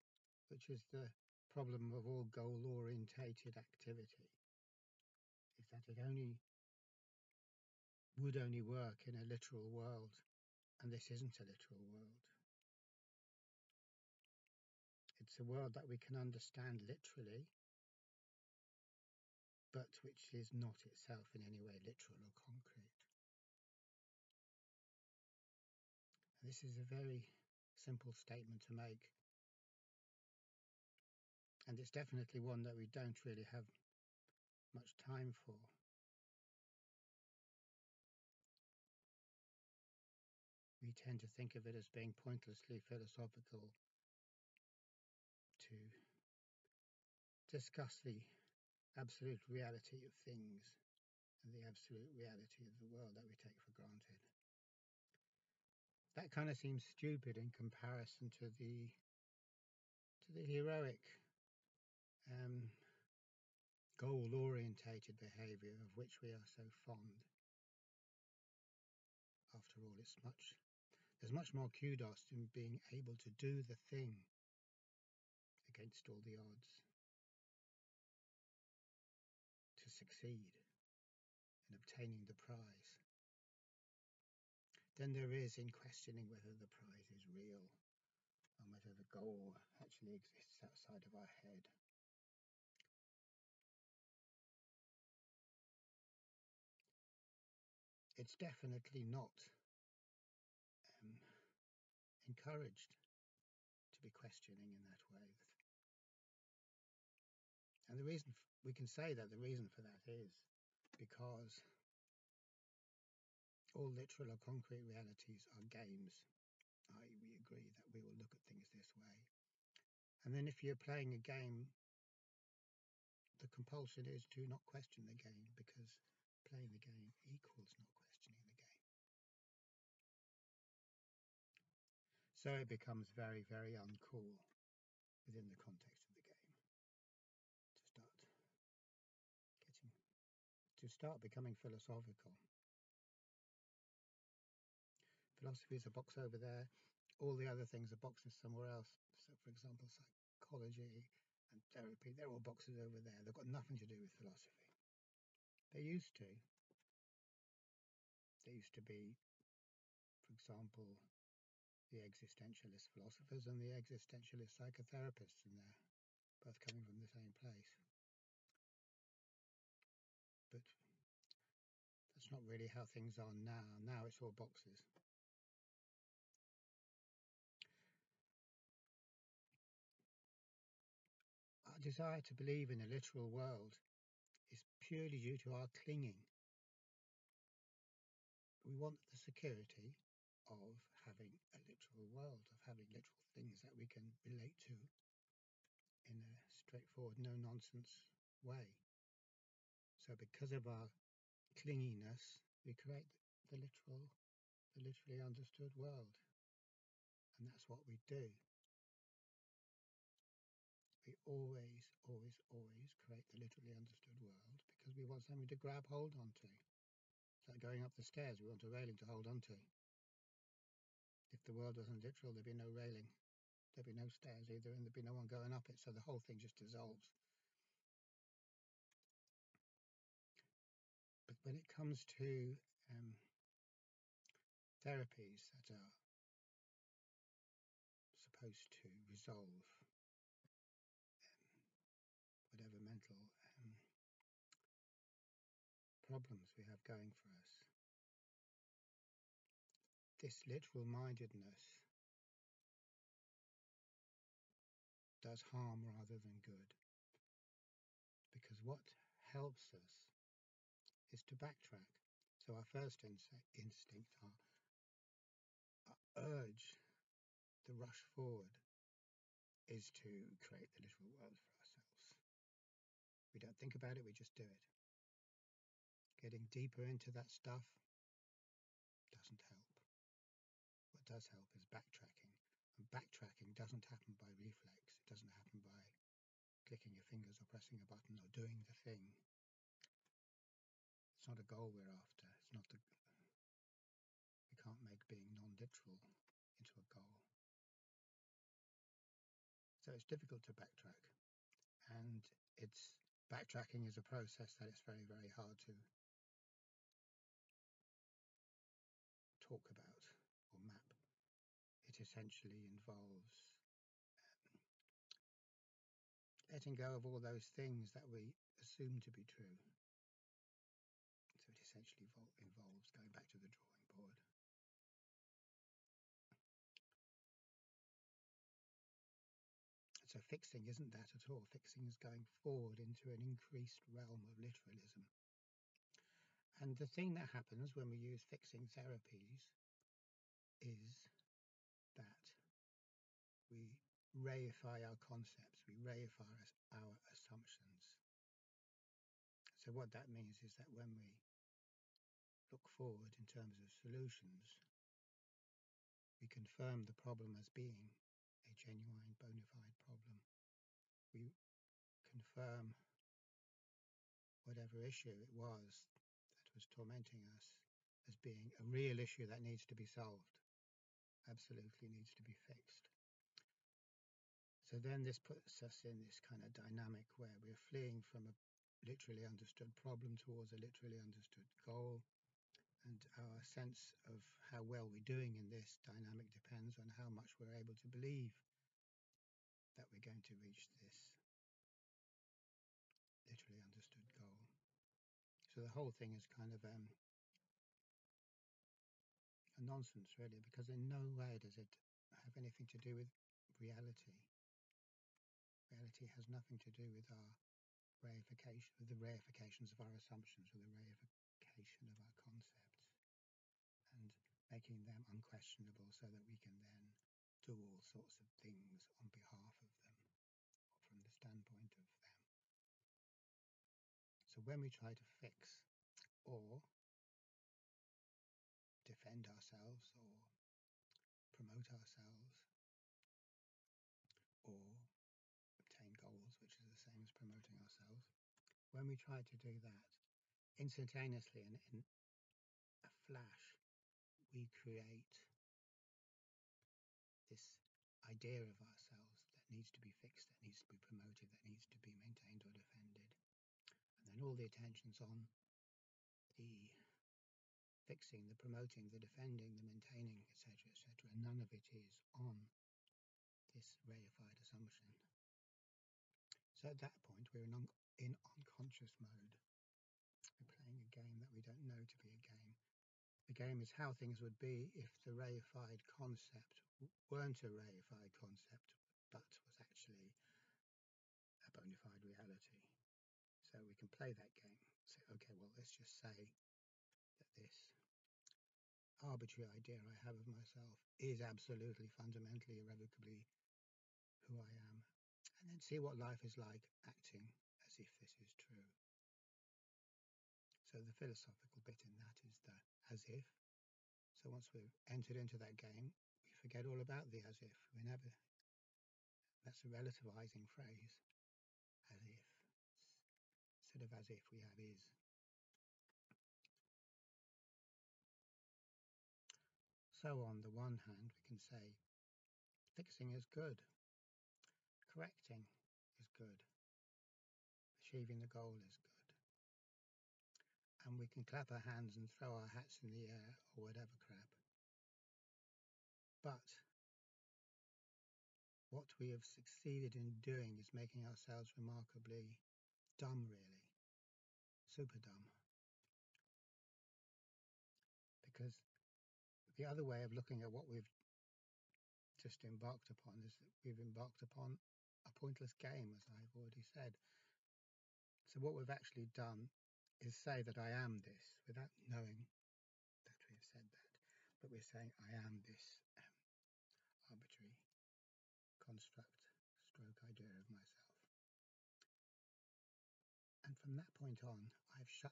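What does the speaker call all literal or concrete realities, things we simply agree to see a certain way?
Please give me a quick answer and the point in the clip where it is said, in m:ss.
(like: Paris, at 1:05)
Games, at 1:55.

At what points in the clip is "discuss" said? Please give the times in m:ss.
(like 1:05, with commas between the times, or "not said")
0:47.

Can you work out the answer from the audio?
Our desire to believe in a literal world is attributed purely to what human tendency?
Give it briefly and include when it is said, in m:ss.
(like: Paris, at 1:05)
Clinging, at 3:05.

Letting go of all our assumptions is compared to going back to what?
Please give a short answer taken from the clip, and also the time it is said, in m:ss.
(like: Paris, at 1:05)
The drawing board, at 5:23.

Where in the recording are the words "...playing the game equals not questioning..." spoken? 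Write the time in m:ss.
2:06.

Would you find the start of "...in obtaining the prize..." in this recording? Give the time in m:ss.
1:21.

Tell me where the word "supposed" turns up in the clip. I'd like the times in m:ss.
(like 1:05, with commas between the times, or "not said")
3:58.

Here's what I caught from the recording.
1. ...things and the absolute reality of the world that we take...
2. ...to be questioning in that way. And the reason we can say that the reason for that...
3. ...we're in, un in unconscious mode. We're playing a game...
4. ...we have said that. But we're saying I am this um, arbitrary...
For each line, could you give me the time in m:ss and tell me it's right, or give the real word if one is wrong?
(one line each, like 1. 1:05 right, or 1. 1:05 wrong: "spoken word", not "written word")
1. 0:50 right
2. 1:43 right
3. 7:47 right
4. 9:23 right.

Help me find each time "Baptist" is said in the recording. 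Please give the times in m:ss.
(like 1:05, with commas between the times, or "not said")
not said.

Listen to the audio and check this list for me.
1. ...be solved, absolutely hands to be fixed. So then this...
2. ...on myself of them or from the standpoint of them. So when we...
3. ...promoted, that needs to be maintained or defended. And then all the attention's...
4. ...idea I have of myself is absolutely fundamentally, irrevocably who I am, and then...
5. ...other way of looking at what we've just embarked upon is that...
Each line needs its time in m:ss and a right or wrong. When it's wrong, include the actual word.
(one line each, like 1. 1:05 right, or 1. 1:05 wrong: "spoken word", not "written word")
1. 6:09 wrong: "needs", not "hands"
2. 6:58 wrong: "behalf", not "myself"
3. 7:30 right
4. 8:09 right
5. 9:09 right.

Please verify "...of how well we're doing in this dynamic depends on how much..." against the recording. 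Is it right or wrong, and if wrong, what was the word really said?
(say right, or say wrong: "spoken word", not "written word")
right.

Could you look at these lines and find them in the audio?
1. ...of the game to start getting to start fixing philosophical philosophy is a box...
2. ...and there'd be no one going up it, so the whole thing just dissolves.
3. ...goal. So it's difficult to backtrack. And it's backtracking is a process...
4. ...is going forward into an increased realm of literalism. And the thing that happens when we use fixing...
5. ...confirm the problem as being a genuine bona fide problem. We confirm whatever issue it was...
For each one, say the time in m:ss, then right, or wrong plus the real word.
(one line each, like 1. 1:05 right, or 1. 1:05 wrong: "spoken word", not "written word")
1. 2:16 wrong: "becoming", not "fixing"
2. 3:44 right
3. 4:56 right
4. 5:31 right
5. 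5:56 right.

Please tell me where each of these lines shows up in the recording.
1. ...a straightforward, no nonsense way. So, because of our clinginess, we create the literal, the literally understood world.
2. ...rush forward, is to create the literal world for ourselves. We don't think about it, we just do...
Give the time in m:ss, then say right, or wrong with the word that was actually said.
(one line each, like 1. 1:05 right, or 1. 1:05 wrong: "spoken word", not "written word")
1. 3:16 right
2. 4:27 right.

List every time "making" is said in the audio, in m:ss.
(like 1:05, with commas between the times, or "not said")
6:54, 9:00.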